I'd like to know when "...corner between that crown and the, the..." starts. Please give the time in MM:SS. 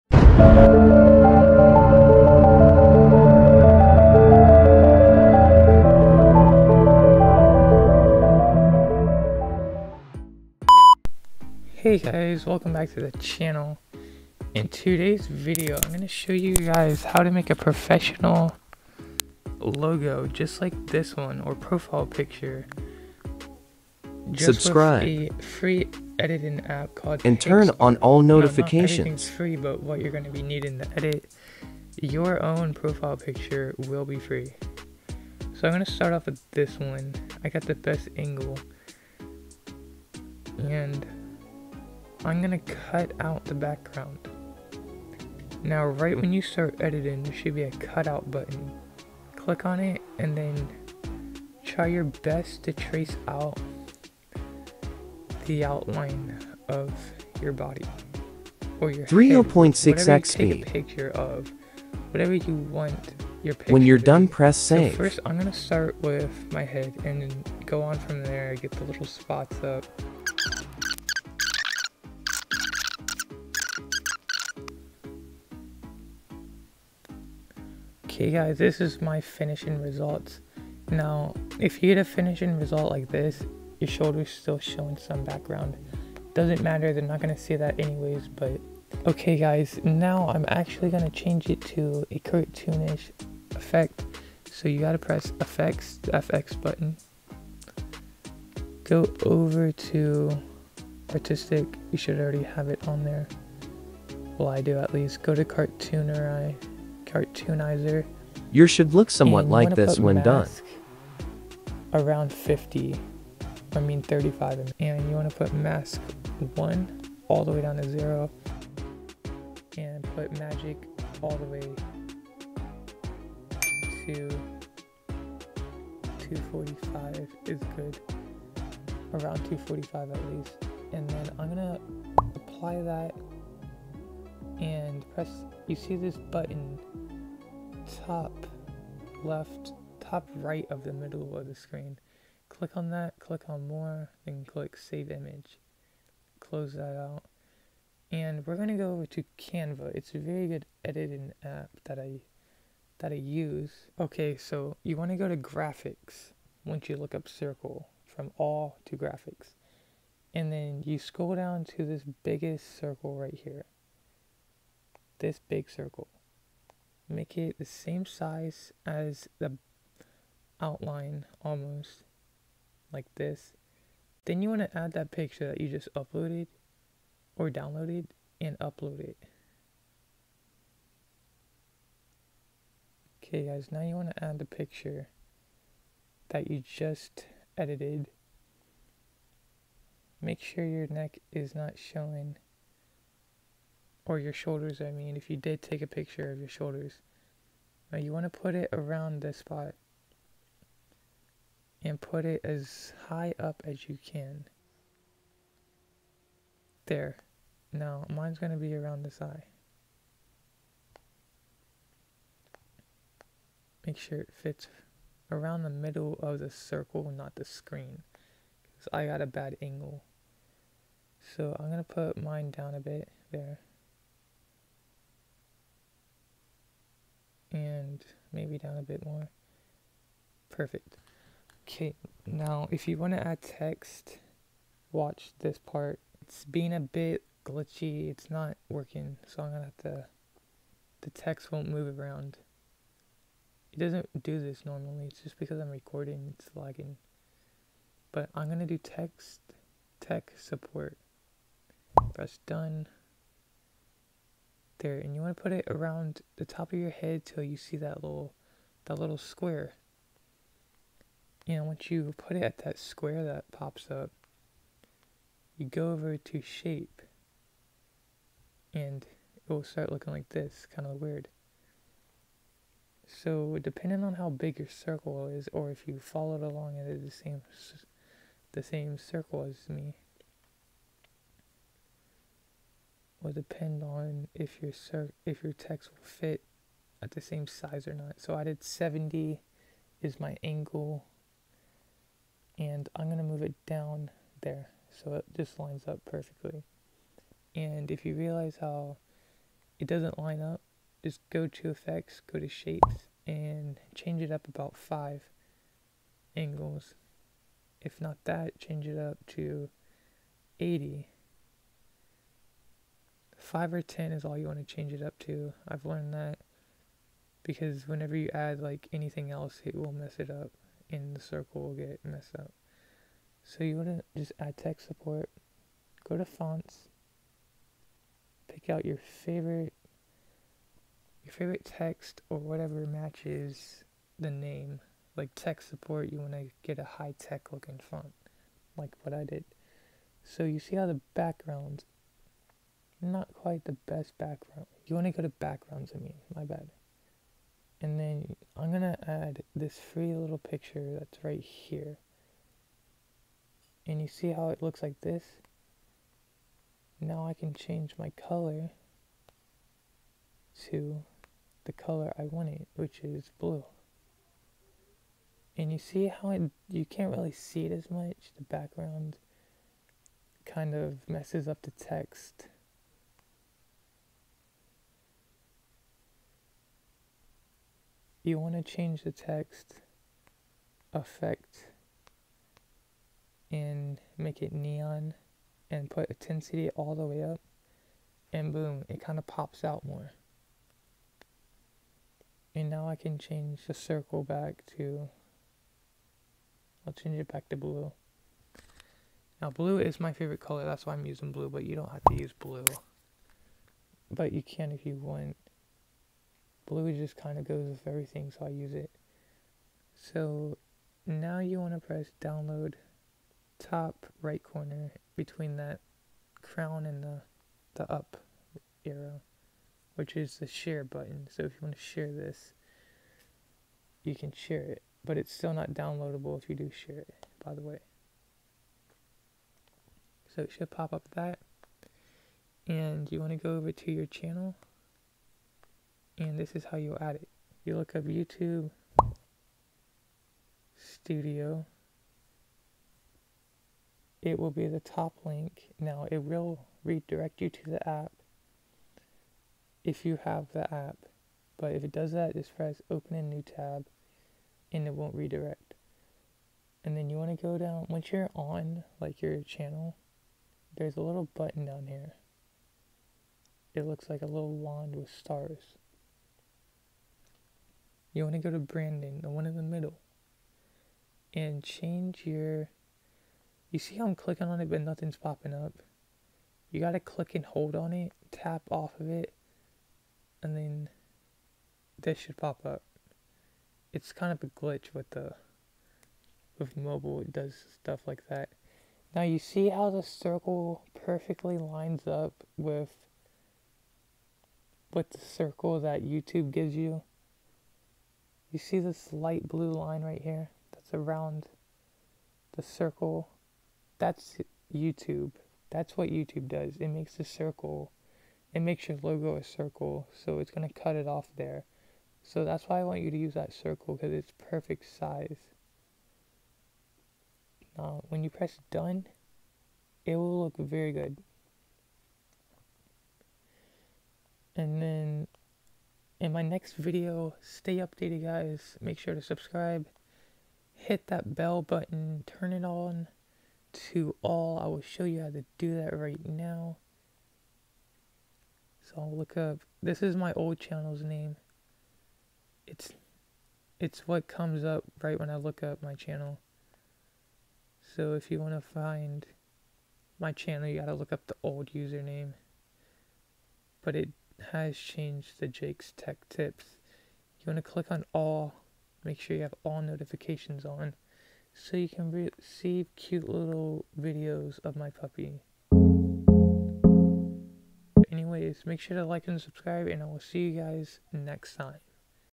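06:54.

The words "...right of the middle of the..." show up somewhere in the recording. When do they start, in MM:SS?
02:20.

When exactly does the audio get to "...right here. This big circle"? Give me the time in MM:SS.
02:43.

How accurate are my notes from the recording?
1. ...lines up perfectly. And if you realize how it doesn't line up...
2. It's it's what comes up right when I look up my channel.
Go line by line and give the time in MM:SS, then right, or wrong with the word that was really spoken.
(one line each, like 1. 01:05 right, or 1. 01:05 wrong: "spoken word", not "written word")
1. 04:55 right
2. 09:02 right.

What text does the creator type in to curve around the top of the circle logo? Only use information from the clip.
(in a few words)
tech support.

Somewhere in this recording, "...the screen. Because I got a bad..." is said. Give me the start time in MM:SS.
03:37.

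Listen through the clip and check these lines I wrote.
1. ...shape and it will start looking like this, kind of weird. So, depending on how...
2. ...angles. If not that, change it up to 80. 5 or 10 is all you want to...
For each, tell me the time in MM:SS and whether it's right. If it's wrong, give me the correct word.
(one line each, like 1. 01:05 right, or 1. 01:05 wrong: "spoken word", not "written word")
1. 04:26 right
2. 05:06 right.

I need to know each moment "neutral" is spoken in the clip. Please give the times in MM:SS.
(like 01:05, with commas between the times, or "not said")
not said.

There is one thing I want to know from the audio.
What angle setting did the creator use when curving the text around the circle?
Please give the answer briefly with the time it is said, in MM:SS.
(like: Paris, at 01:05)
70, at 04:48.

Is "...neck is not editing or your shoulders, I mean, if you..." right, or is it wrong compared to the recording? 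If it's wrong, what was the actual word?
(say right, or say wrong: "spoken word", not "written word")
wrong: "showing", not "editing".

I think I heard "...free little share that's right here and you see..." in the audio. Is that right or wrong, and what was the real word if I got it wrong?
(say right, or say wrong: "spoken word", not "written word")
wrong: "picture", not "share".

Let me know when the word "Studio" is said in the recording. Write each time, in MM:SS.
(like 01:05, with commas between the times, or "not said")
07:20.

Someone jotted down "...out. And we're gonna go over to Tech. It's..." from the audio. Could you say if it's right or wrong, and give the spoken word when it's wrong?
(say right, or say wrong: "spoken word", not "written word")
wrong: "Canva", not "Tech".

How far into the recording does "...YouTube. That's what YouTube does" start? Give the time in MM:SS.
08:24.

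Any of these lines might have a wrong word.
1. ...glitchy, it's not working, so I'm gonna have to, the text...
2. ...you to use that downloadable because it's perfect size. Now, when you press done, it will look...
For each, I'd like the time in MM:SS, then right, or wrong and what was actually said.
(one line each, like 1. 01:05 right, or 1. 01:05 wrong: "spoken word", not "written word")
1. 03:57 right
2. 08:33 wrong: "circle", not "downloadable".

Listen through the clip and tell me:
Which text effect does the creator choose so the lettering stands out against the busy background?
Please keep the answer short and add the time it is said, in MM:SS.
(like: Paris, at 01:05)
neon, at 06:24.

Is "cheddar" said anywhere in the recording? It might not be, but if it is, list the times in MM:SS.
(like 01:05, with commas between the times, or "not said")
not said.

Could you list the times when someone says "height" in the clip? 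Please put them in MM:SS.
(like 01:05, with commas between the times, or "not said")
not said.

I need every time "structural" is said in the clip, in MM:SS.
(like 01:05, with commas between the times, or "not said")
not said.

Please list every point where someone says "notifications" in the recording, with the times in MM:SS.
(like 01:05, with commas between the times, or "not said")
00:28, 09:19.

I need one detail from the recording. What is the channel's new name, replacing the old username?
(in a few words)
Jake's Tech Tips.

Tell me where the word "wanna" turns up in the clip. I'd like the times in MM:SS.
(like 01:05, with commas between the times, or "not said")
02:34, 04:15, 05:23, 05:36.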